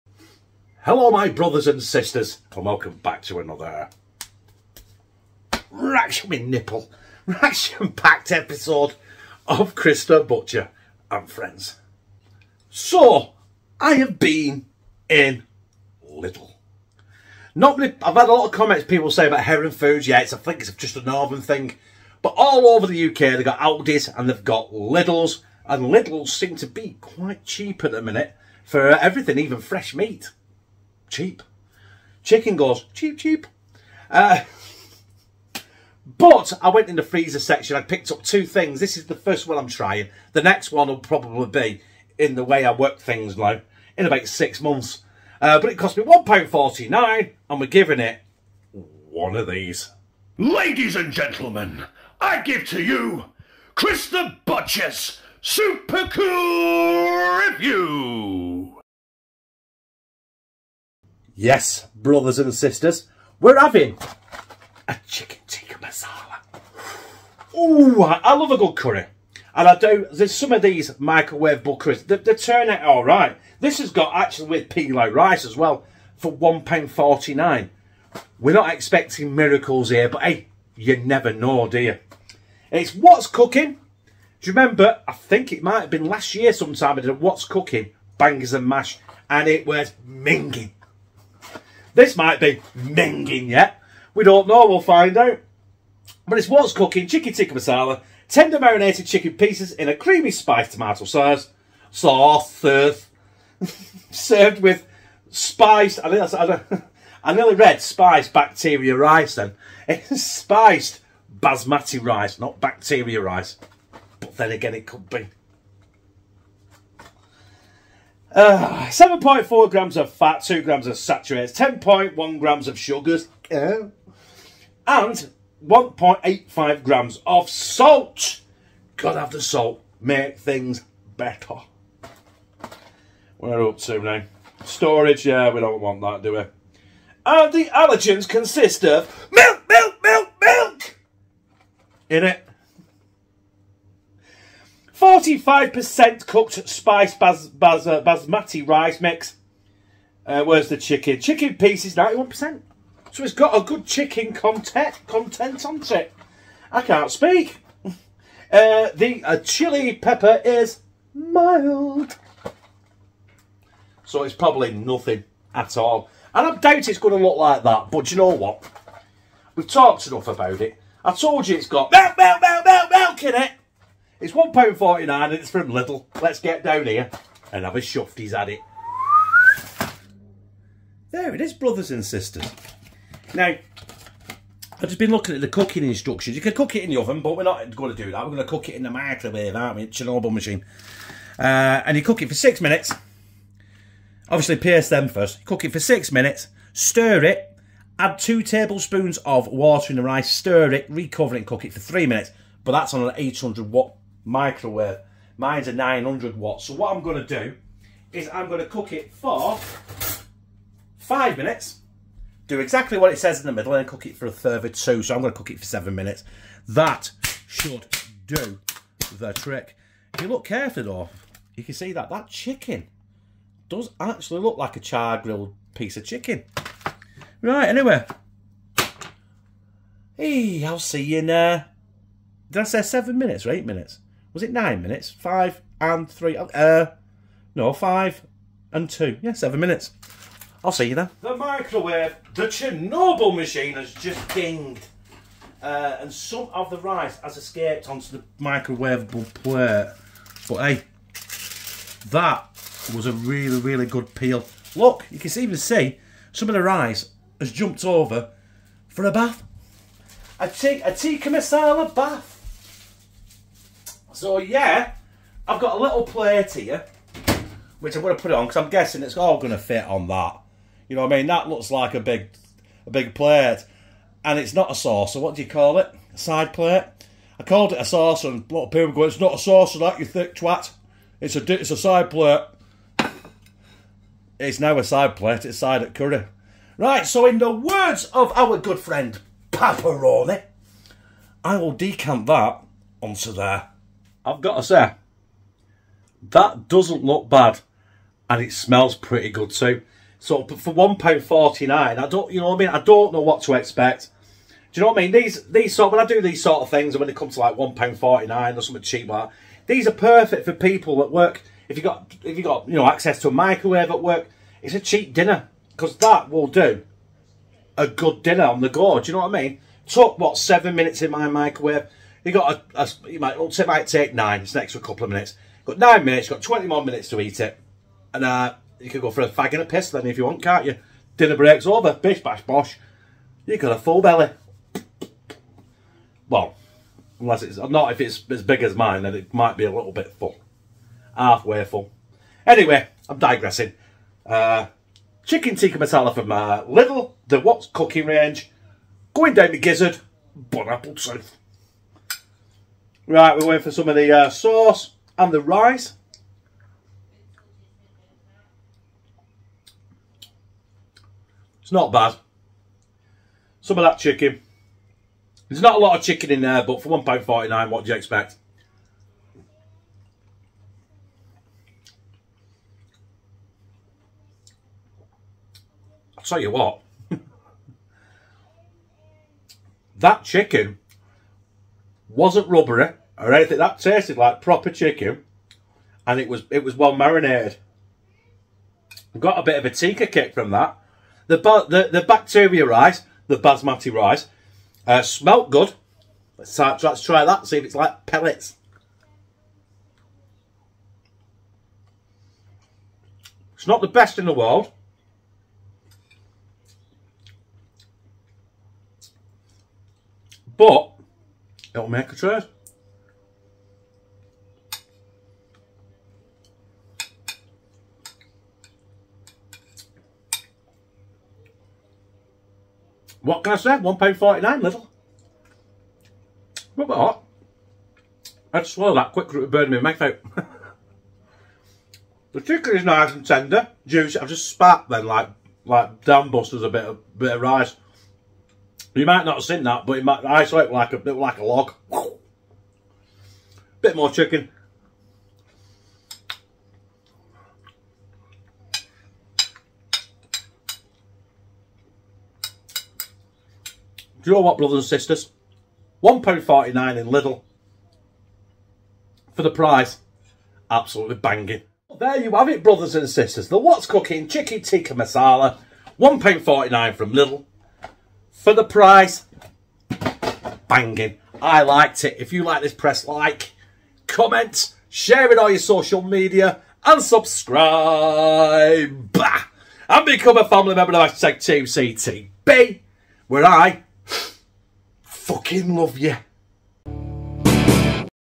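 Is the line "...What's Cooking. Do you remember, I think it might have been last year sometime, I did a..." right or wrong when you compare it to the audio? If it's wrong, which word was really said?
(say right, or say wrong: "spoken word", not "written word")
right.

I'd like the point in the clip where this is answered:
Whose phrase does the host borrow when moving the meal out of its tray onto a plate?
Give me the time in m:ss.
4:49.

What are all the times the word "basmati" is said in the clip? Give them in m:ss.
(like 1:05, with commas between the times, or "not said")
1:51, 2:28, 6:33.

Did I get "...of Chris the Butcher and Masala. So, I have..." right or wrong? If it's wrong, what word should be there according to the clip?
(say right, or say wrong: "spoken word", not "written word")
wrong: "Friends", not "Masala".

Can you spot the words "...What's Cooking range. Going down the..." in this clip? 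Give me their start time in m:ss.
5:47.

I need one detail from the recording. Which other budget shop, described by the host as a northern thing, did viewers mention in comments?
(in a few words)
Heron Foods.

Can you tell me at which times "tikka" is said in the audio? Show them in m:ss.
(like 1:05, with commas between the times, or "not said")
1:05, 1:37, 4:20, 5:45, 6:29, 7:44.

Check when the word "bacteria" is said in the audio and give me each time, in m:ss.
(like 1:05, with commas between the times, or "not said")
1:48, 1:52, 6:32.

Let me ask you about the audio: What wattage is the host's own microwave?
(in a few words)
900 watt.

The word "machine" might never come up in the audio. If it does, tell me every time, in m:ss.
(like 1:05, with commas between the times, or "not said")
3:10, 4:03.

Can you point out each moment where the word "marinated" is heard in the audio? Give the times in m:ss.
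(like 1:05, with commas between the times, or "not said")
1:38, 6:26.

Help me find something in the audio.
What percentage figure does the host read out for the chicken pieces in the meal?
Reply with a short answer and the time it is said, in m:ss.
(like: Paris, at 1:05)
91%, at 2:31.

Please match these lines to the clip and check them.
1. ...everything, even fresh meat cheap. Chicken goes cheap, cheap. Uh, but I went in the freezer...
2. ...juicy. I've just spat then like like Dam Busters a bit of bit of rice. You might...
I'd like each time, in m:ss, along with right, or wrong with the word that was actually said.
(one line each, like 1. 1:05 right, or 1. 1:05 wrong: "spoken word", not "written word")
1. 0:28 right
2. 7:13 right.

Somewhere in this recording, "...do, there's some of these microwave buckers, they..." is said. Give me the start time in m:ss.
1:09.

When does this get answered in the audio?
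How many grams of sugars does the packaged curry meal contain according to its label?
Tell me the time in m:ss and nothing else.
2:01.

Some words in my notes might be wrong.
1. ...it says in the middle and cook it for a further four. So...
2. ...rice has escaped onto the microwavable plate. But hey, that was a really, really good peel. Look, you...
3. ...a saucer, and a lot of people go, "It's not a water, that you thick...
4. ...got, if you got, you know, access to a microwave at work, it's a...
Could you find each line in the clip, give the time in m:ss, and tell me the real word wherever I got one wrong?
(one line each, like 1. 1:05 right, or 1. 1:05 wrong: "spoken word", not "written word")
1. 3:33 wrong: "two", not "four"
2. 4:06 right
3. 4:37 wrong: "saucer", not "water"
4. 5:11 right.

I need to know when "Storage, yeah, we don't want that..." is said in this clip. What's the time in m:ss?
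2:14.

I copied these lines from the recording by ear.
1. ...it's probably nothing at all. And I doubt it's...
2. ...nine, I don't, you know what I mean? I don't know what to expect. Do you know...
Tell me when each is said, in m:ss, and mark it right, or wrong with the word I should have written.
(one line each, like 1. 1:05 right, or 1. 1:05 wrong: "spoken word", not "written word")
1. 2:44 right
2. 5:01 right.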